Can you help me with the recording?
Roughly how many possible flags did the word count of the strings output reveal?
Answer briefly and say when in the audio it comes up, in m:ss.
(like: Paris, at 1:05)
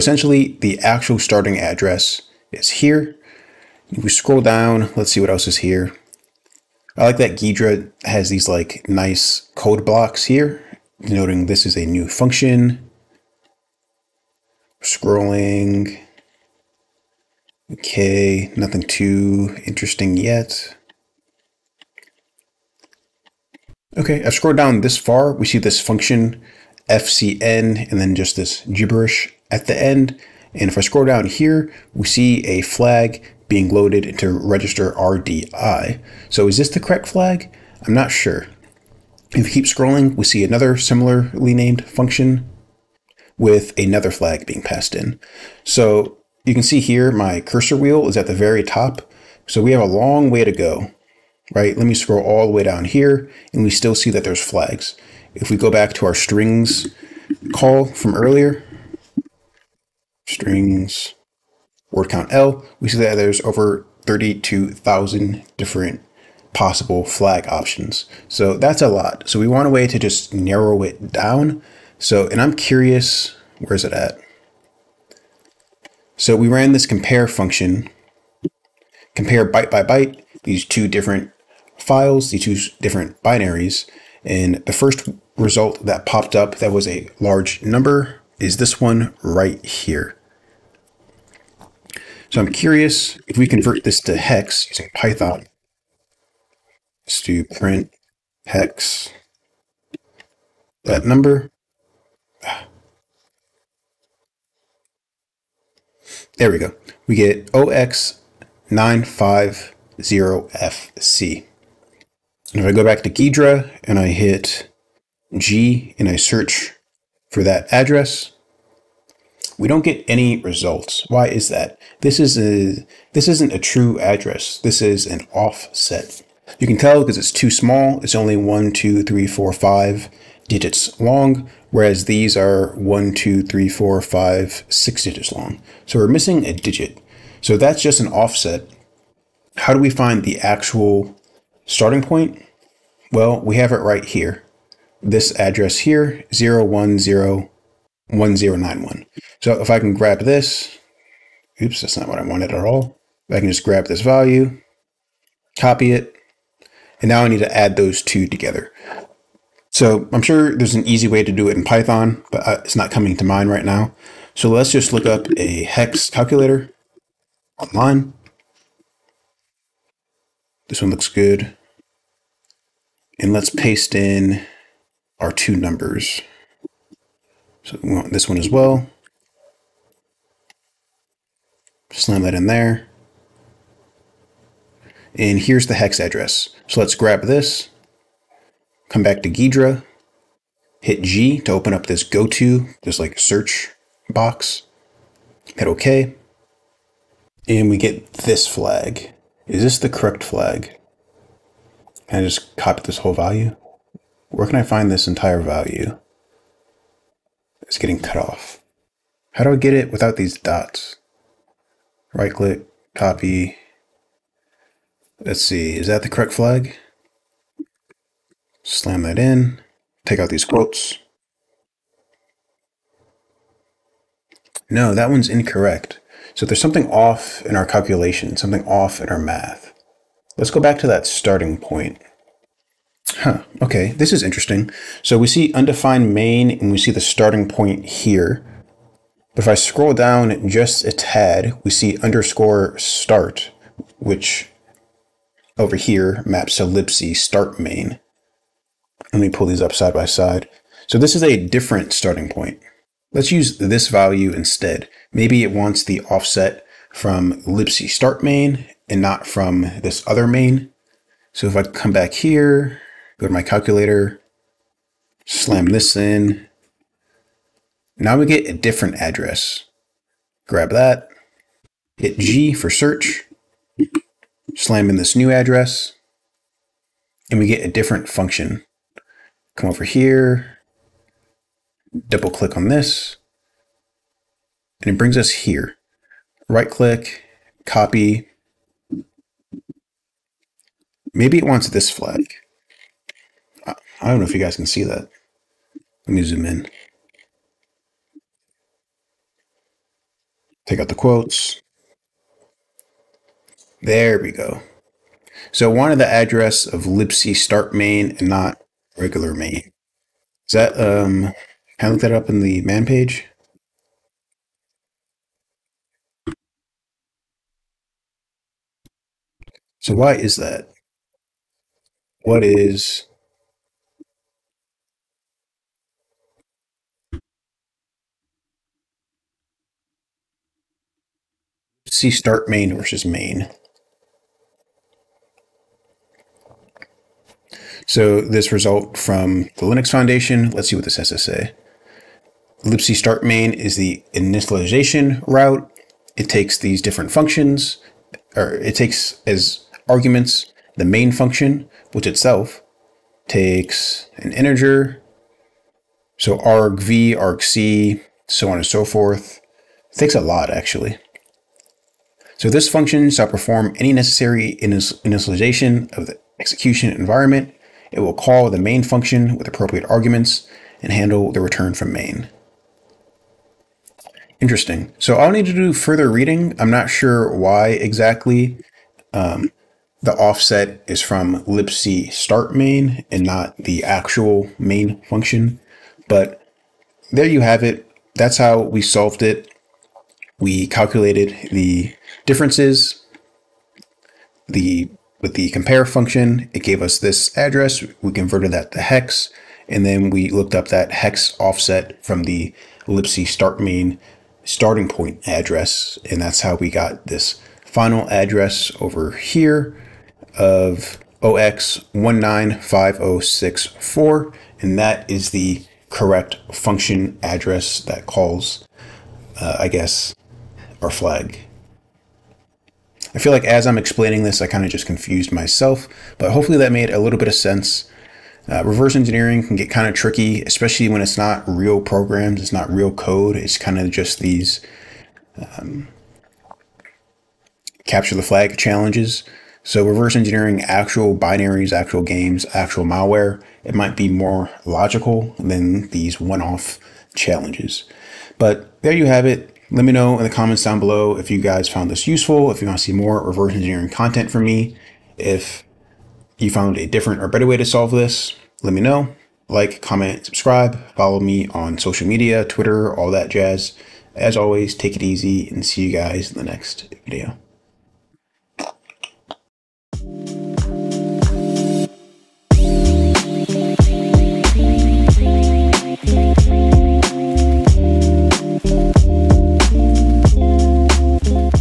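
32,000, at 1:04.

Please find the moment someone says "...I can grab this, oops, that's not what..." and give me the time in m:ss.
2:29.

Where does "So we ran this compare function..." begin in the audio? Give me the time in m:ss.
1:16.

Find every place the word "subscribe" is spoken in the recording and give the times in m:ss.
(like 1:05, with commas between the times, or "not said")
7:40.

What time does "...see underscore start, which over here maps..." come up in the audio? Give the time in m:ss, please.
4:01.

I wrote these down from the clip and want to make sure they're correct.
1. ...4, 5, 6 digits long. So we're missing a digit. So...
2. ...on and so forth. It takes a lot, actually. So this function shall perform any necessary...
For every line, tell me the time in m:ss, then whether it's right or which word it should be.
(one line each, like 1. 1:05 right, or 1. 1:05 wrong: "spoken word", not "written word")
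1. 2:13 right
2. 5:58 right.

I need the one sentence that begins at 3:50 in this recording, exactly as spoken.
Let's go back to that starting point.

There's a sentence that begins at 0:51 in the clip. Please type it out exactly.
Let me scroll all the way down here and we still see that there's flags.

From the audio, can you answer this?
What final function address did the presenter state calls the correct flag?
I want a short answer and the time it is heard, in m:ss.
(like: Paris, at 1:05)
0x195064, at 6:51.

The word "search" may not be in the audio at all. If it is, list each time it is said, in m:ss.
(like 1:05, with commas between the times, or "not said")
1:56, 3:13, 4:32.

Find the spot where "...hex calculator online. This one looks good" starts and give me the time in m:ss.
2:45.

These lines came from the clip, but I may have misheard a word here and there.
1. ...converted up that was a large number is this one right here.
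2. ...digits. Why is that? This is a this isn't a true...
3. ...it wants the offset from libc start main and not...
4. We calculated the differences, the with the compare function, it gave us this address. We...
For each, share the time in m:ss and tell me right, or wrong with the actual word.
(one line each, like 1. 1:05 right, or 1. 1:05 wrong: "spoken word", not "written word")
1. 1:26 wrong: "popped", not "converted"
2. 2:00 wrong: "results", not "digits"
3. 4:15 right
4. 6:30 right.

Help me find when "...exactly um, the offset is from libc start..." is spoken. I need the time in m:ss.
6:17.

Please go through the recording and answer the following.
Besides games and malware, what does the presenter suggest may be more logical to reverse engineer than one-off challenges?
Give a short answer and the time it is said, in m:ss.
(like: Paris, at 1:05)
actual binaries, at 7:20.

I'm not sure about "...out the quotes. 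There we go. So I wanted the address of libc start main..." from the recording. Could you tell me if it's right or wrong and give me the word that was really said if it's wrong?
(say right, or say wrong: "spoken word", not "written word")
right.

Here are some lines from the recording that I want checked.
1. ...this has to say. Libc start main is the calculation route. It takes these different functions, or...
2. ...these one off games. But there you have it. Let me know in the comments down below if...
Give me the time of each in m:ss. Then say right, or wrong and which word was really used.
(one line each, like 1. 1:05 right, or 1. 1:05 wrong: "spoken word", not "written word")
1. 5:40 wrong: "initialization", not "calculation"
2. 7:25 wrong: "challenges", not "games".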